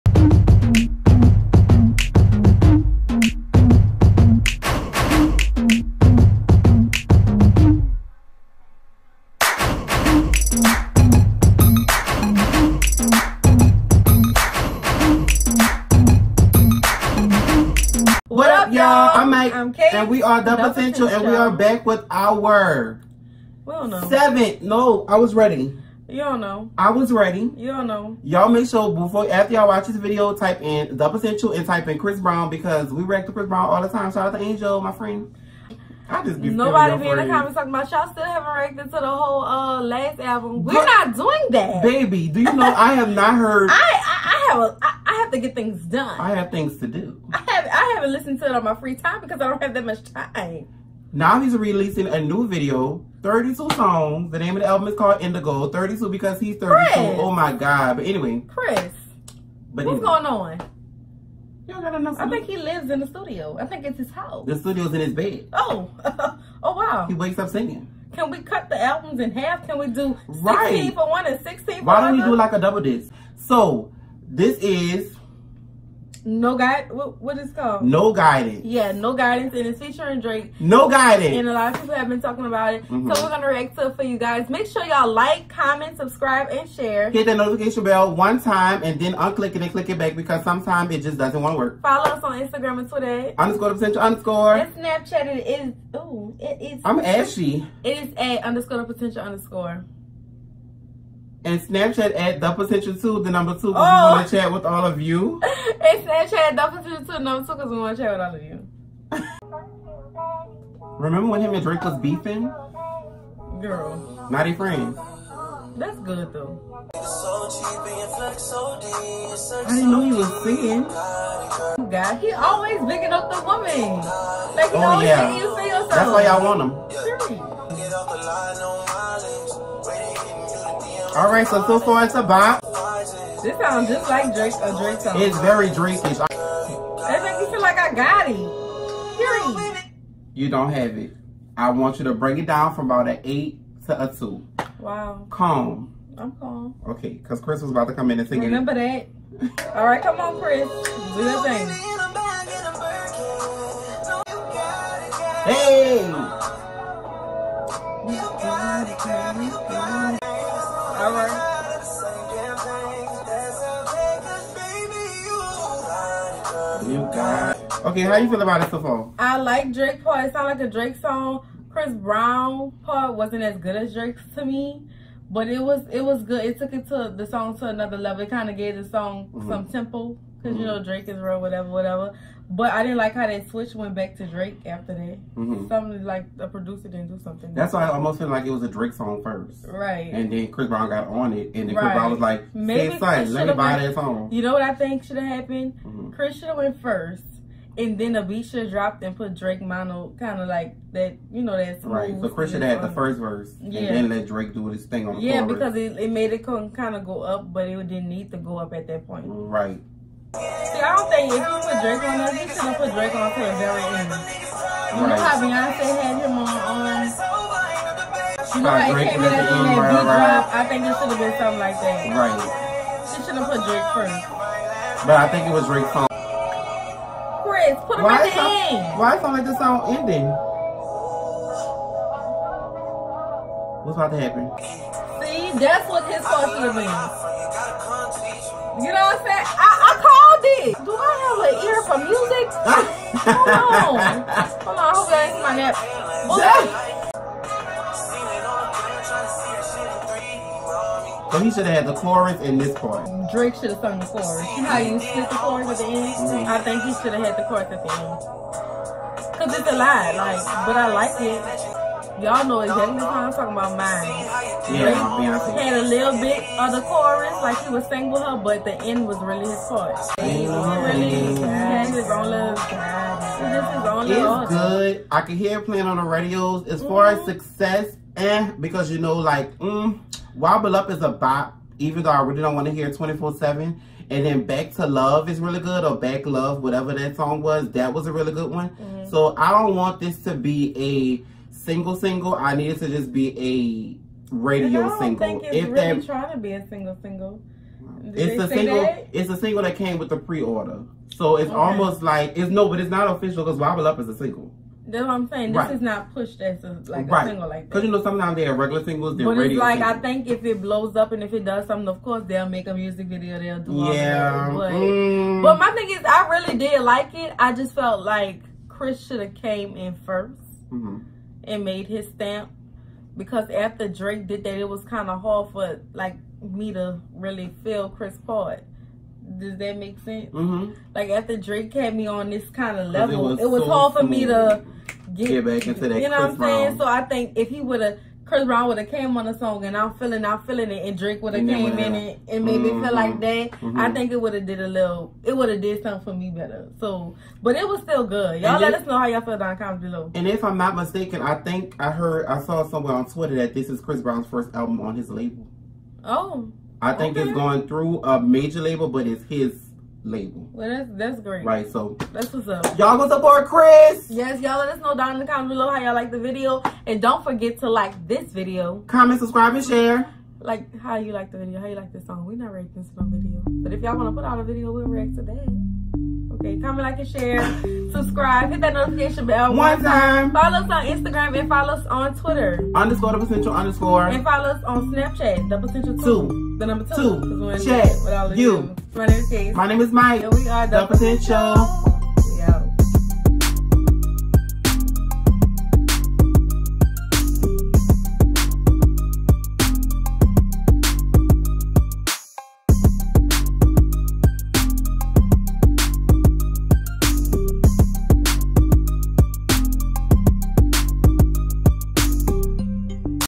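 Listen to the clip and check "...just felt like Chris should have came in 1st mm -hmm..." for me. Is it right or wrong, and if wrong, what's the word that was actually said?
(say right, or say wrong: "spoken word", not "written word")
right.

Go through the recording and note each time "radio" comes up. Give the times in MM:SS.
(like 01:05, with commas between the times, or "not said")
04:36, 04:54, 05:09.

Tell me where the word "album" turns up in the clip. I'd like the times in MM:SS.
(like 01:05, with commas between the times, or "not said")
00:40, 00:54, 01:08, 05:54.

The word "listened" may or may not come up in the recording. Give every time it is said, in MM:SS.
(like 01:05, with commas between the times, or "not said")
00:48.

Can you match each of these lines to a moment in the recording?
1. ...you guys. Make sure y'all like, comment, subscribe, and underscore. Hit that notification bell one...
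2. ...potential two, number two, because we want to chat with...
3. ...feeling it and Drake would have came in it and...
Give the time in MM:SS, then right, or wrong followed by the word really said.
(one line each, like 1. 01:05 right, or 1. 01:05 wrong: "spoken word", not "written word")
1. 01:24 wrong: "share", not "underscore"
2. 01:46 right
3. 05:40 right.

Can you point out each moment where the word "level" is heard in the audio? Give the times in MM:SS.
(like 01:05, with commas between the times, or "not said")
02:57, 05:32.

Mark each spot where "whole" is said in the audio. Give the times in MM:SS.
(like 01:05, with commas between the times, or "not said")
00:39.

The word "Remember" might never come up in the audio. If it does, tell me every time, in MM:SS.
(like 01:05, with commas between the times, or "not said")
01:50, 02:28.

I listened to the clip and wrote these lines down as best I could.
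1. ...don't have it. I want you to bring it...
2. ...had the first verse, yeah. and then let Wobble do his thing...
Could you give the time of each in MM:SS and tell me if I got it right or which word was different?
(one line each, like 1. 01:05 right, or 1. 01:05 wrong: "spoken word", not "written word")
1. 02:20 right
2. 03:22 wrong: "Drake", not "Wobble".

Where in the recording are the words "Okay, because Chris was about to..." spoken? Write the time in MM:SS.
02:26.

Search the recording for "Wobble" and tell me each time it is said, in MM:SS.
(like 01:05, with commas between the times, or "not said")
04:40, 05:03.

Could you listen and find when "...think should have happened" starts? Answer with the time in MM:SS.
03:14.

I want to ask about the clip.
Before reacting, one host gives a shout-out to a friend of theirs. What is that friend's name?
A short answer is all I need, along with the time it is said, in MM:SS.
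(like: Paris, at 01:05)
Angel, at 00:34.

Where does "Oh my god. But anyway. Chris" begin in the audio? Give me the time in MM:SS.
00:57.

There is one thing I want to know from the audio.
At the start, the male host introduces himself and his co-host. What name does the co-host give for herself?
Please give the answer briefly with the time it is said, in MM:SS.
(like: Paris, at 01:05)
Kate, at 00:19.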